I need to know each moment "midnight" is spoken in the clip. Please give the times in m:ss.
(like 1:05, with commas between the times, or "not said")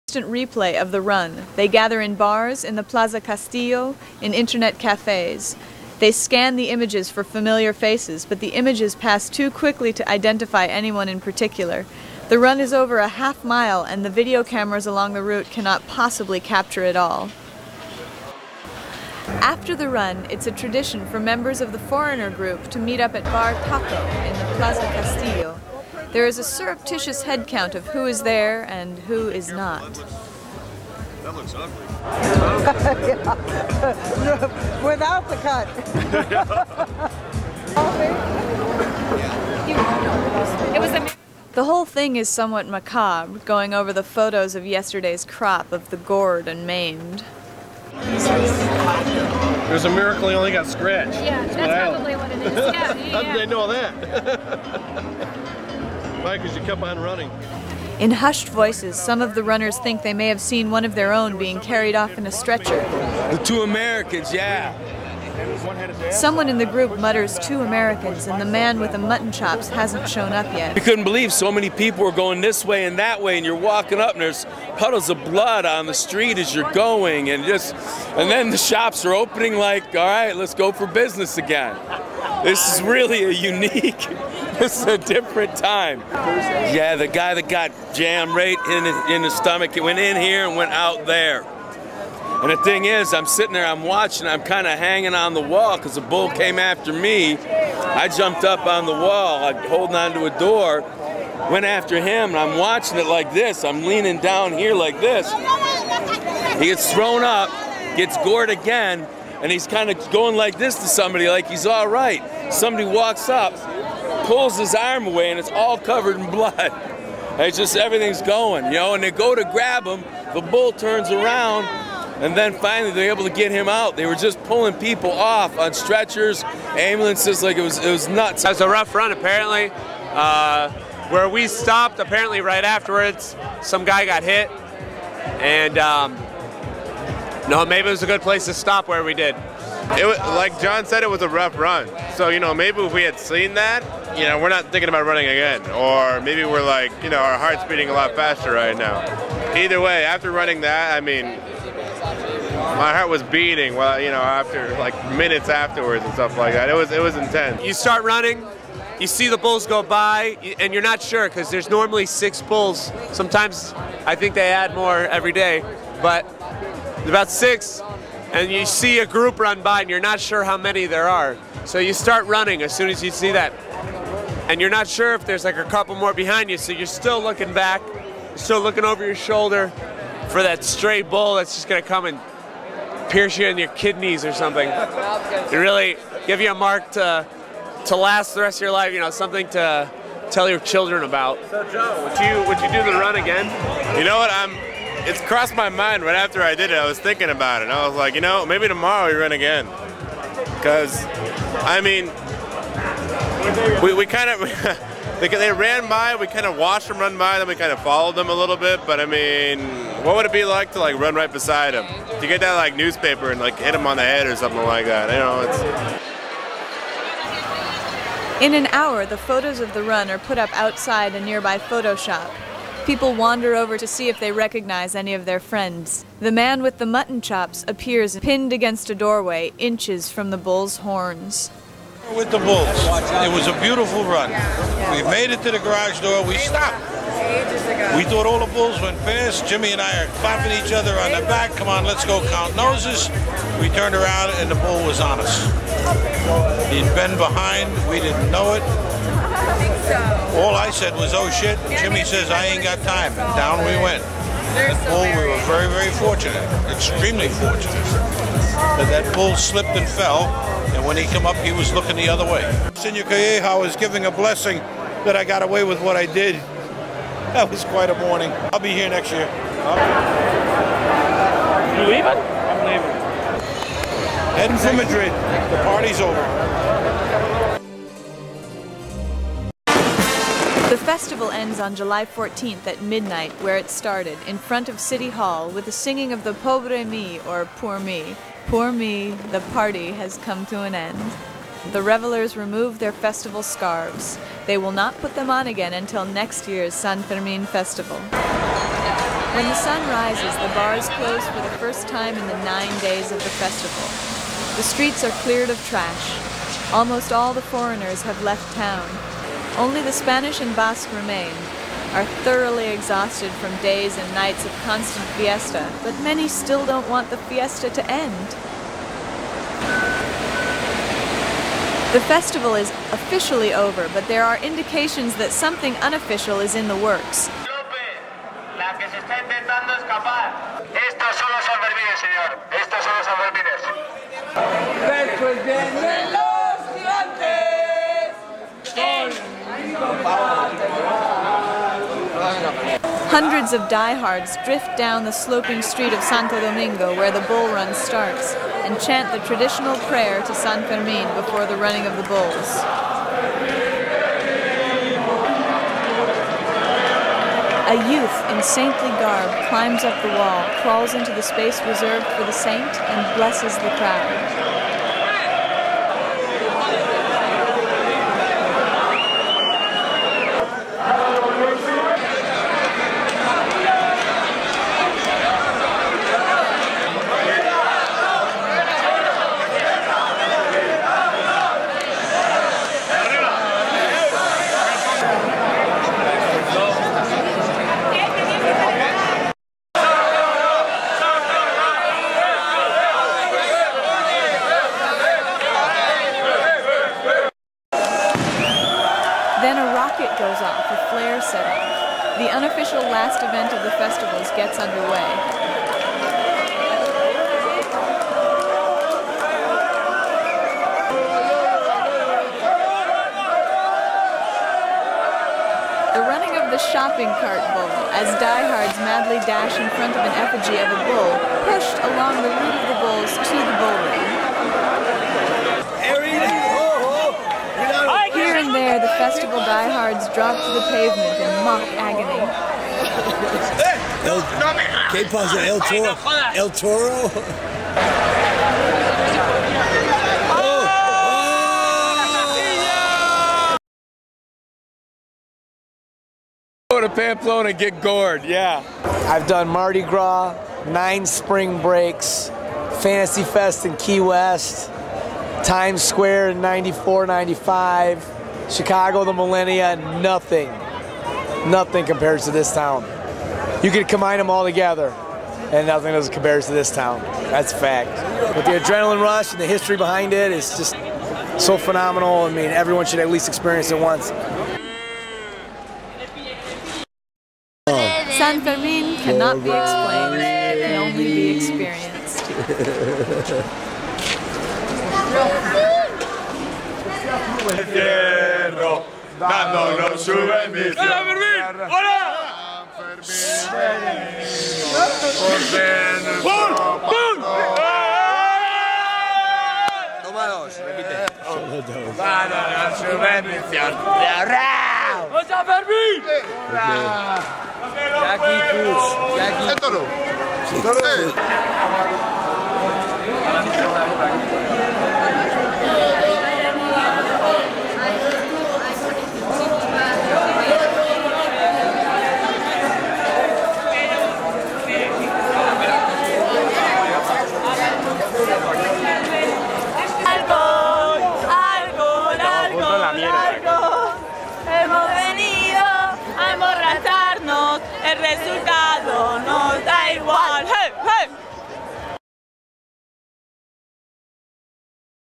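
4:42.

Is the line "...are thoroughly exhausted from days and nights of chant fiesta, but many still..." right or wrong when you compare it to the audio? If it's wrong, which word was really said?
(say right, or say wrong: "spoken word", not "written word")
wrong: "constant", not "chant".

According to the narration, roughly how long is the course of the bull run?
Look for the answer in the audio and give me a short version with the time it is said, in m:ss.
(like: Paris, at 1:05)
Over a half mile, at 0:12.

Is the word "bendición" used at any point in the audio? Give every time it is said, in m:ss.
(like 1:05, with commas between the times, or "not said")
8:10, 8:22.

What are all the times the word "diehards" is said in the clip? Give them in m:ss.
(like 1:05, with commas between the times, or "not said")
5:43, 7:09.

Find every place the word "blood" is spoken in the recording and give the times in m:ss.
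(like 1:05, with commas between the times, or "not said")
1:15, 1:56.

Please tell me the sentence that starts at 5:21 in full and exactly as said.
The festival is officially over, but there are indications that something unofficial is in the works.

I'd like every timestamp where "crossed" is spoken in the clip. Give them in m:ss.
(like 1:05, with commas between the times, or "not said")
3:15.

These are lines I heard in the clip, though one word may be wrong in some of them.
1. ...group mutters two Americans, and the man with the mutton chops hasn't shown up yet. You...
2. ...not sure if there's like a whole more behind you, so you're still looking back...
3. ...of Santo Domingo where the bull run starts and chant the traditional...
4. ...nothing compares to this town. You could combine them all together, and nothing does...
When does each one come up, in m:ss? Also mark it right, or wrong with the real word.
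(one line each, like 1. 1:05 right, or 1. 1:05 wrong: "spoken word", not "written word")
1. 1:06 right
2. 2:54 wrong: "couple", not "whole"
3. 5:45 right
4. 7:41 right.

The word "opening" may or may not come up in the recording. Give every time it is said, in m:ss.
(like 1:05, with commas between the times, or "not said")
1:19.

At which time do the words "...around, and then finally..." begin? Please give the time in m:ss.
2:01.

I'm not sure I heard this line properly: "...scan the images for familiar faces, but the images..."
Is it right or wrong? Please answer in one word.
right.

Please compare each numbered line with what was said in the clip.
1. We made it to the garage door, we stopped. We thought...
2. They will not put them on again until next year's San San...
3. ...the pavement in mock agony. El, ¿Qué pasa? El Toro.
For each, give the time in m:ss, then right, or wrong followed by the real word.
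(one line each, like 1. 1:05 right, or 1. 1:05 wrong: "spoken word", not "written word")
1. 3:54 right
2. 4:54 wrong: "Fermin", not "San"
3. 7:10 right.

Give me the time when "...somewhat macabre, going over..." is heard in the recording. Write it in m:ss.
0:42.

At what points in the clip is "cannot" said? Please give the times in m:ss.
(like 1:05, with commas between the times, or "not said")
0:15, 7:58.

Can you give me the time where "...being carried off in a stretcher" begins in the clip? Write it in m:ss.
1:01.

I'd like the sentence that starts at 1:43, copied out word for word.
I'm leaning down here like this.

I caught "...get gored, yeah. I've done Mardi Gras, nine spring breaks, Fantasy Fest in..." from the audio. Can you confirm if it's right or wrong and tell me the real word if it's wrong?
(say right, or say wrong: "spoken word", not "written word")
right.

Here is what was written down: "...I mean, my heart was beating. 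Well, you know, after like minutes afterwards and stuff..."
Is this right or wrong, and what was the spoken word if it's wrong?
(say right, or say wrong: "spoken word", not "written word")
right.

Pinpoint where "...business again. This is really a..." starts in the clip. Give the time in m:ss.
1:20.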